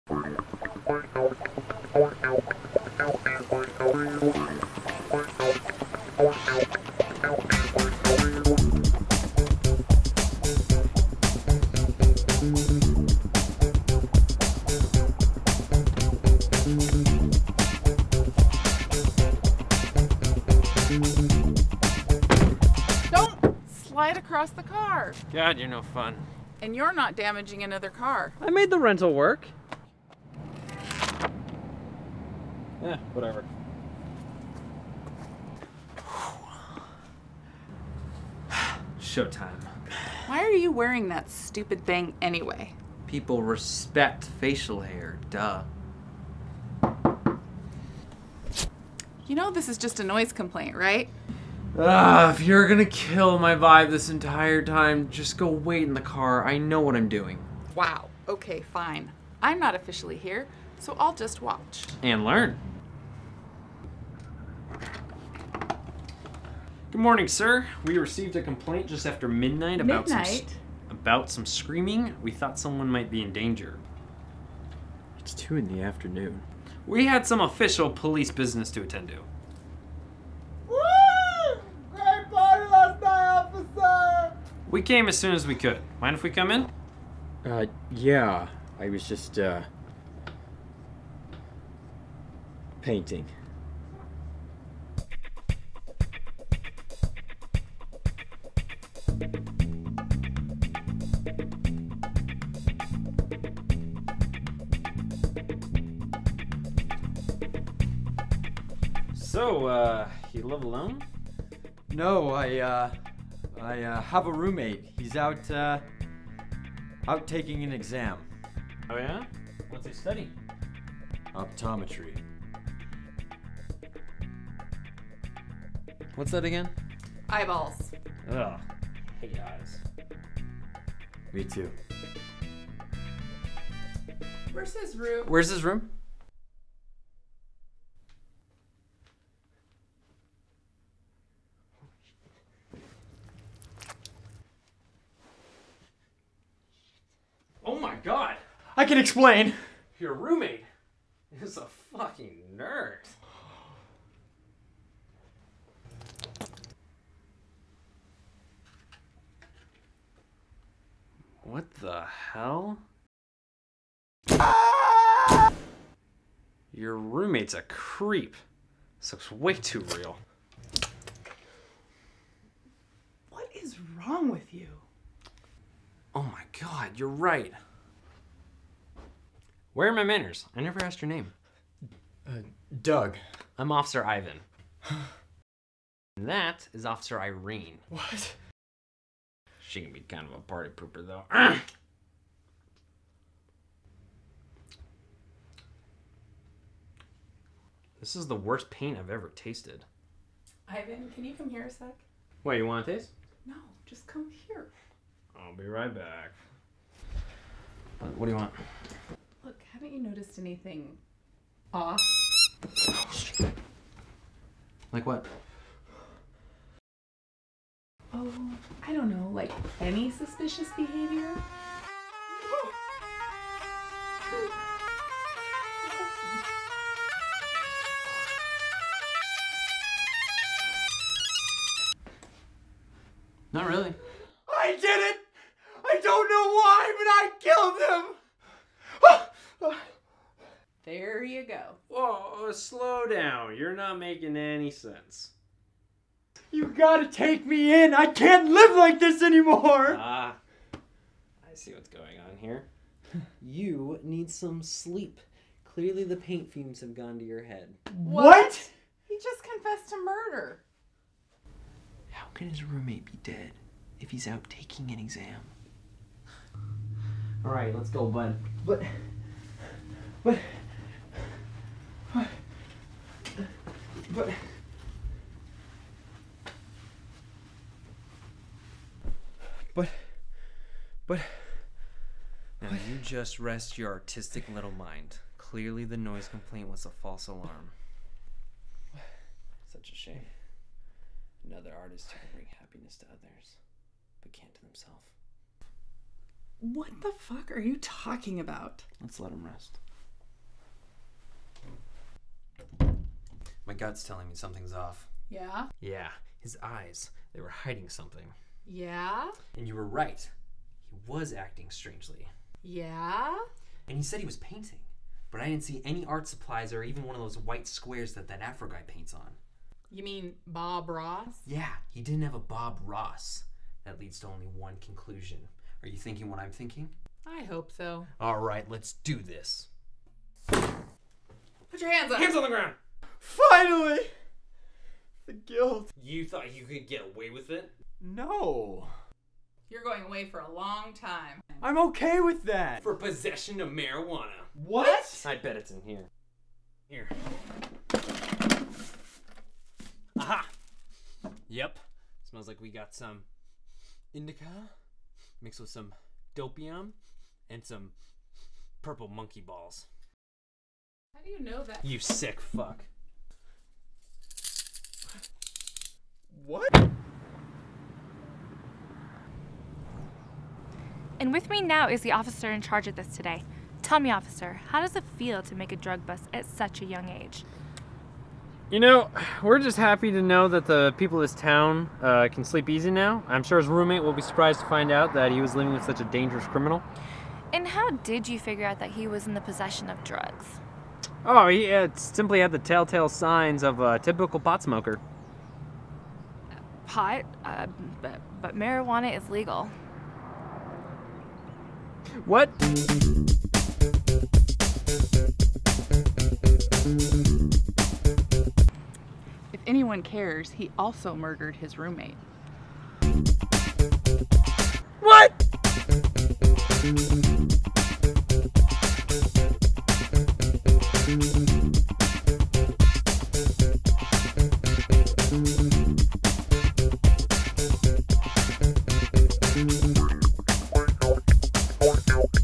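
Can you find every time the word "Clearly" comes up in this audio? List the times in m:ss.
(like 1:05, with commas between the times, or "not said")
4:15, 4:45.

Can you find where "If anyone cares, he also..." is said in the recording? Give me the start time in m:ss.
6:49.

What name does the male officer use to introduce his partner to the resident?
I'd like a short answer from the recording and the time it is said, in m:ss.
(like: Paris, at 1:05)
Officer Irene, at 3:06.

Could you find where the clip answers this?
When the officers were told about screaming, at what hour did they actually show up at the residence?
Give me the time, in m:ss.
1:15.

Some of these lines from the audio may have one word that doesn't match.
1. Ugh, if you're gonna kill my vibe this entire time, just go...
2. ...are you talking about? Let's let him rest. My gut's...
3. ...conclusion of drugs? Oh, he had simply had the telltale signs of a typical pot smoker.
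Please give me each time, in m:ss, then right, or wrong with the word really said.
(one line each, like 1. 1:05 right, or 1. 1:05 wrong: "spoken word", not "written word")
1. 0:51 right
2. 4:57 right
3. 6:29 wrong: "possession", not "conclusion".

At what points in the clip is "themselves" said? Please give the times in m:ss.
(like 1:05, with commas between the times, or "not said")
4:54.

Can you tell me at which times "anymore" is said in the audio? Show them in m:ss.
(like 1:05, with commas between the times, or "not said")
4:09.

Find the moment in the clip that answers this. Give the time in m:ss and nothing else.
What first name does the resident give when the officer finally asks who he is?
3:02.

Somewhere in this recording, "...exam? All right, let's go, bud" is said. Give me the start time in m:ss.
4:24.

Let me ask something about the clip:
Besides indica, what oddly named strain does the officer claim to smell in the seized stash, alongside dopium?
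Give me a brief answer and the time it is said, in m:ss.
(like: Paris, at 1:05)
purple monkey balls, at 5:58.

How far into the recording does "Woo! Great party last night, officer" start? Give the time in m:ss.
1:20.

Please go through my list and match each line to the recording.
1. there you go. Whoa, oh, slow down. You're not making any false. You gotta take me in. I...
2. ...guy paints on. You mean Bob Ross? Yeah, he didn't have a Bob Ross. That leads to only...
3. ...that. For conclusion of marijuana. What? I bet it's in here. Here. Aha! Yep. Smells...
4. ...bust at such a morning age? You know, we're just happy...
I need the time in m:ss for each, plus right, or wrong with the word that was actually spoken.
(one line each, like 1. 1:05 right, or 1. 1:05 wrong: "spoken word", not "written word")
1. 4:00 wrong: "sense", not "false"
2. 5:18 right
3. 5:42 wrong: "possession", not "conclusion"
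4. 6:16 wrong: "young", not "morning".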